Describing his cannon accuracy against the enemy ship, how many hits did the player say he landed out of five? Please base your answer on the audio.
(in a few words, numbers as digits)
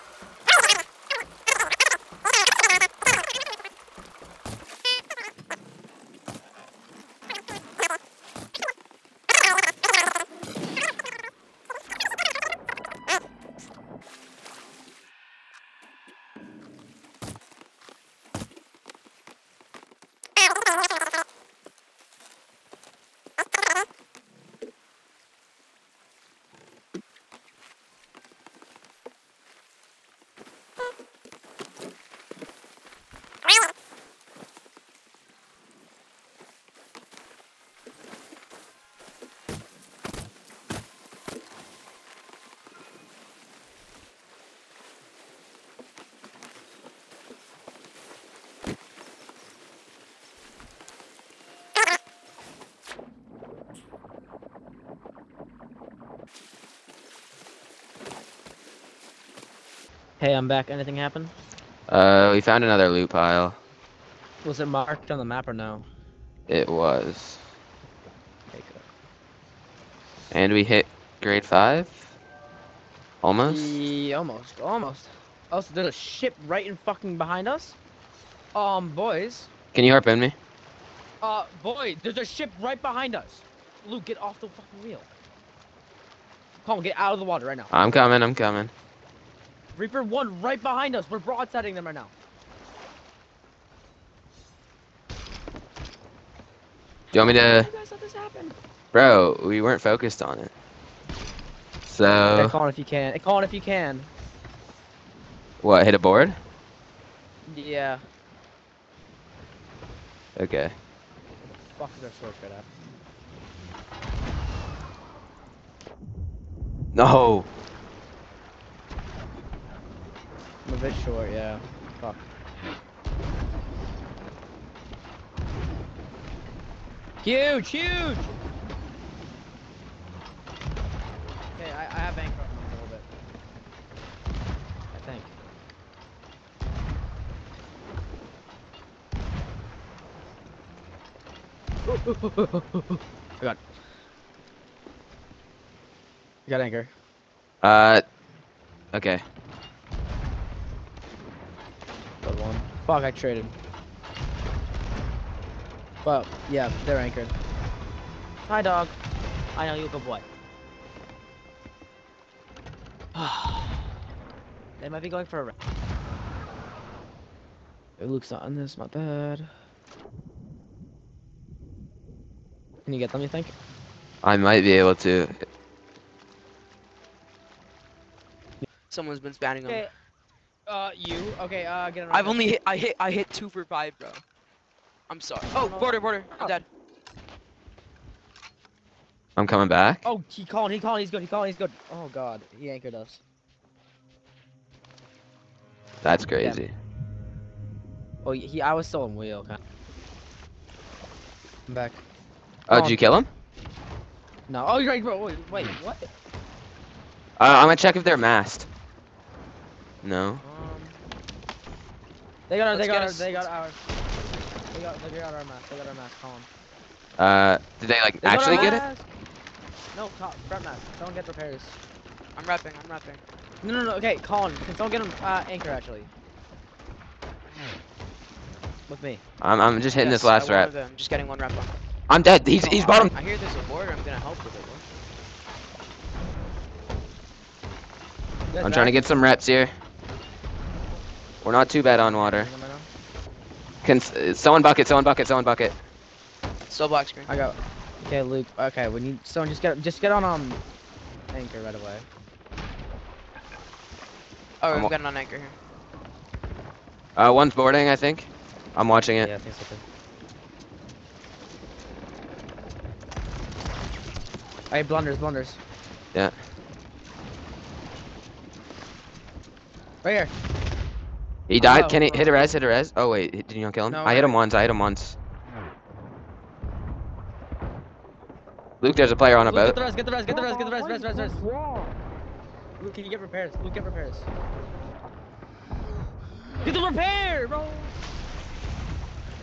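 2.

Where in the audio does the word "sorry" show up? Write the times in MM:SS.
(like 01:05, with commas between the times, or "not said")
03:05.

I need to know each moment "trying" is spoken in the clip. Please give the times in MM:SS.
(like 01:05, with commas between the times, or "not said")
03:58.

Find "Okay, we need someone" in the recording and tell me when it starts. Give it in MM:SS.
04:08.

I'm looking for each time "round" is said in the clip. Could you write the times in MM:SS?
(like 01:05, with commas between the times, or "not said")
02:45.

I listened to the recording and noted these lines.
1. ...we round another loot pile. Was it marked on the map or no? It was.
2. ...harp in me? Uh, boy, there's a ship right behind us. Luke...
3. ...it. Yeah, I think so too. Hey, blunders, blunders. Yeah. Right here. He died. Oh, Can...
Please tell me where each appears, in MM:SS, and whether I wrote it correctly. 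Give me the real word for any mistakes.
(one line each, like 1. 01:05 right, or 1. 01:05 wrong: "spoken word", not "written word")
1. 01:02 wrong: "found", not "round"
2. 01:19 right
3. 04:19 right.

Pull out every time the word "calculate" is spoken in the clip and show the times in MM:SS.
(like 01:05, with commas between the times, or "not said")
not said.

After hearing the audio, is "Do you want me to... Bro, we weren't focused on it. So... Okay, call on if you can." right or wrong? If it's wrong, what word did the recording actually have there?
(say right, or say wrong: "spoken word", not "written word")
right.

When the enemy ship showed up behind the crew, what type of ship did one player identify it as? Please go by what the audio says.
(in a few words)
Reaper 1.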